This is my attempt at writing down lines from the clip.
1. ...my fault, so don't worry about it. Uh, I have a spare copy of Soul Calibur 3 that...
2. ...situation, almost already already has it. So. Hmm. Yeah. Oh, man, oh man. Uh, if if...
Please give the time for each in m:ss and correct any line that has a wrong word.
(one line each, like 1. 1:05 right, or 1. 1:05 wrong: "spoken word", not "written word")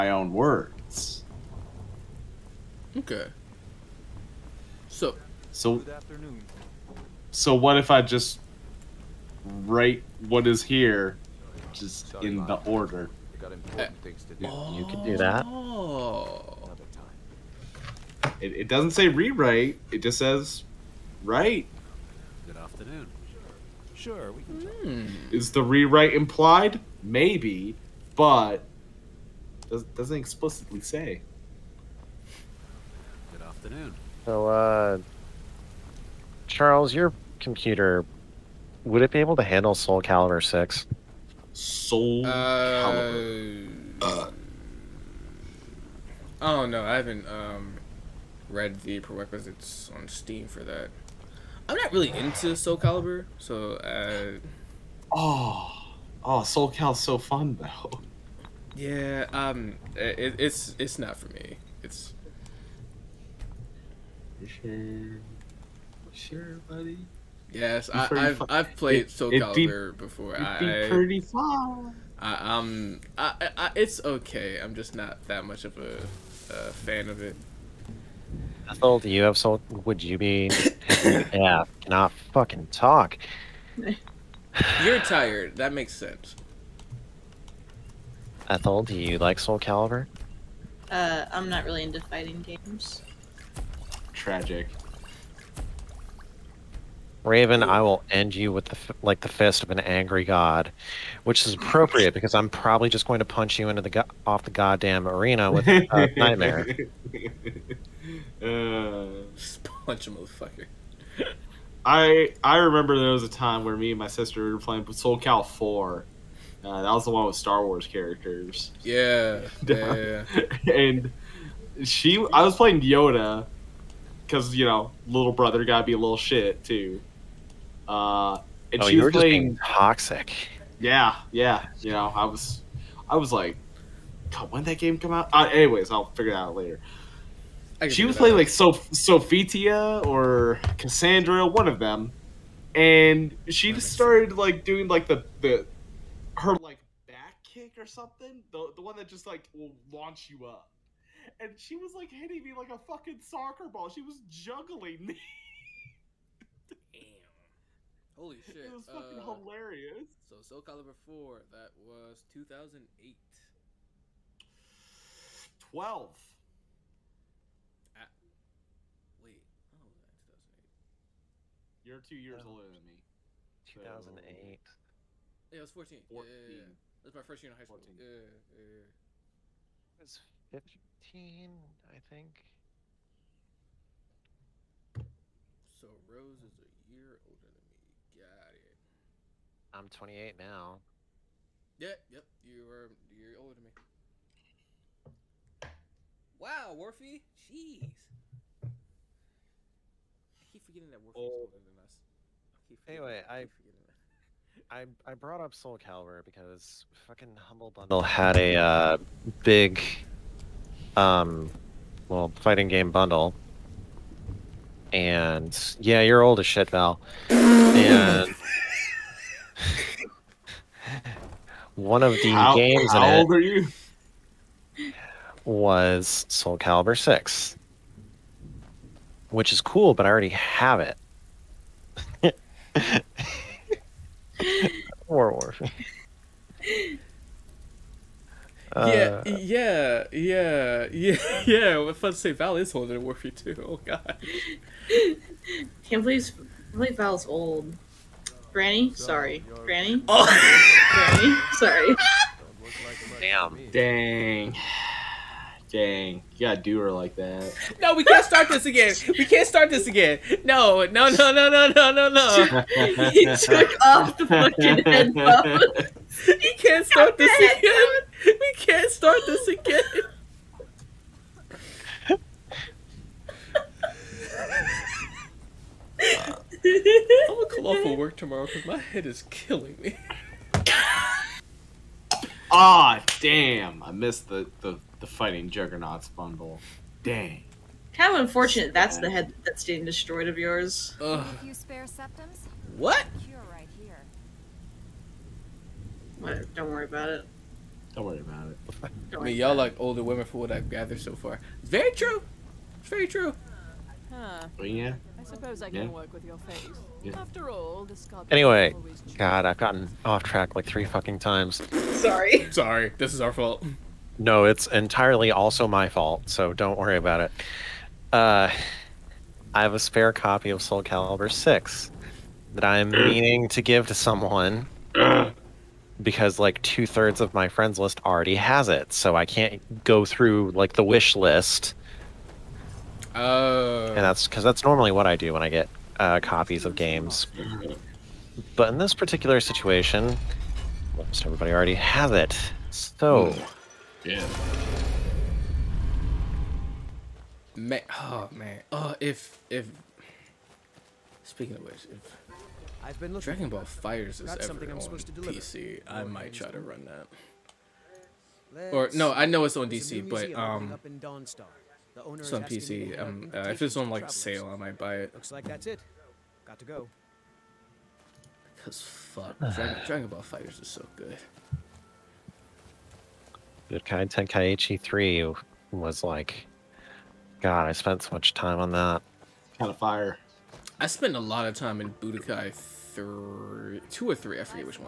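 1. 5:15 wrong: "6", not "3"
2. 5:39 wrong: "everybody", not "already".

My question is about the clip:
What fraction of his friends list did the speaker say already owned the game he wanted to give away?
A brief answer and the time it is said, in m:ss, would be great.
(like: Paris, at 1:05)
Two thirds, at 5:26.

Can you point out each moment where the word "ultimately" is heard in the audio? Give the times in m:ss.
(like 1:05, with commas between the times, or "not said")
not said.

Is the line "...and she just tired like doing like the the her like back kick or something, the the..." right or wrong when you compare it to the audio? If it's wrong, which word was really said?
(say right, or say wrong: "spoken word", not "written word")
wrong: "started", not "tired".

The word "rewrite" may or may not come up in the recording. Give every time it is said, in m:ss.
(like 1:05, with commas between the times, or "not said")
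0:19, 0:25.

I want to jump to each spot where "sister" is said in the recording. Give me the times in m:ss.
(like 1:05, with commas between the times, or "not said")
1:54.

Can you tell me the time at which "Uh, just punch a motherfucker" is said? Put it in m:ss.
1:48.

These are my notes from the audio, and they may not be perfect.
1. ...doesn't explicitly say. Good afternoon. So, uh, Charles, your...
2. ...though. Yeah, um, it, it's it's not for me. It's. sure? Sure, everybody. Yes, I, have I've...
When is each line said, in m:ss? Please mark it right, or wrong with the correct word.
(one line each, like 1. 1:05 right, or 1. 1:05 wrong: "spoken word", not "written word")
1. 0:29 right
2. 0:57 wrong: "buddy", not "everybody".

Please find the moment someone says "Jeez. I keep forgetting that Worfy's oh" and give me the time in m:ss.
3:17.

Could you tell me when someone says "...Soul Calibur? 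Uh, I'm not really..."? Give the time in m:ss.
1:29.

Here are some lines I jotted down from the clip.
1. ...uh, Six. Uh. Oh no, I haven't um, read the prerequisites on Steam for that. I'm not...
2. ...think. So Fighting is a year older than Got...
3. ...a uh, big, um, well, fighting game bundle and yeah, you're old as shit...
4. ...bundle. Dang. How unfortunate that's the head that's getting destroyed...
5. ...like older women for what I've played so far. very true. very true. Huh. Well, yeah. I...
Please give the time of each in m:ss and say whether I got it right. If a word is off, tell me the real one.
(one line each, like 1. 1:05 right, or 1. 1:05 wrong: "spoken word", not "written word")
1. 0:42 wrong: "Calibur", not "Six"
2. 3:01 wrong: "Rose", not "Fighting"
3. 3:28 right
4. 4:46 right
5. 4:59 wrong: "gathered", not "played".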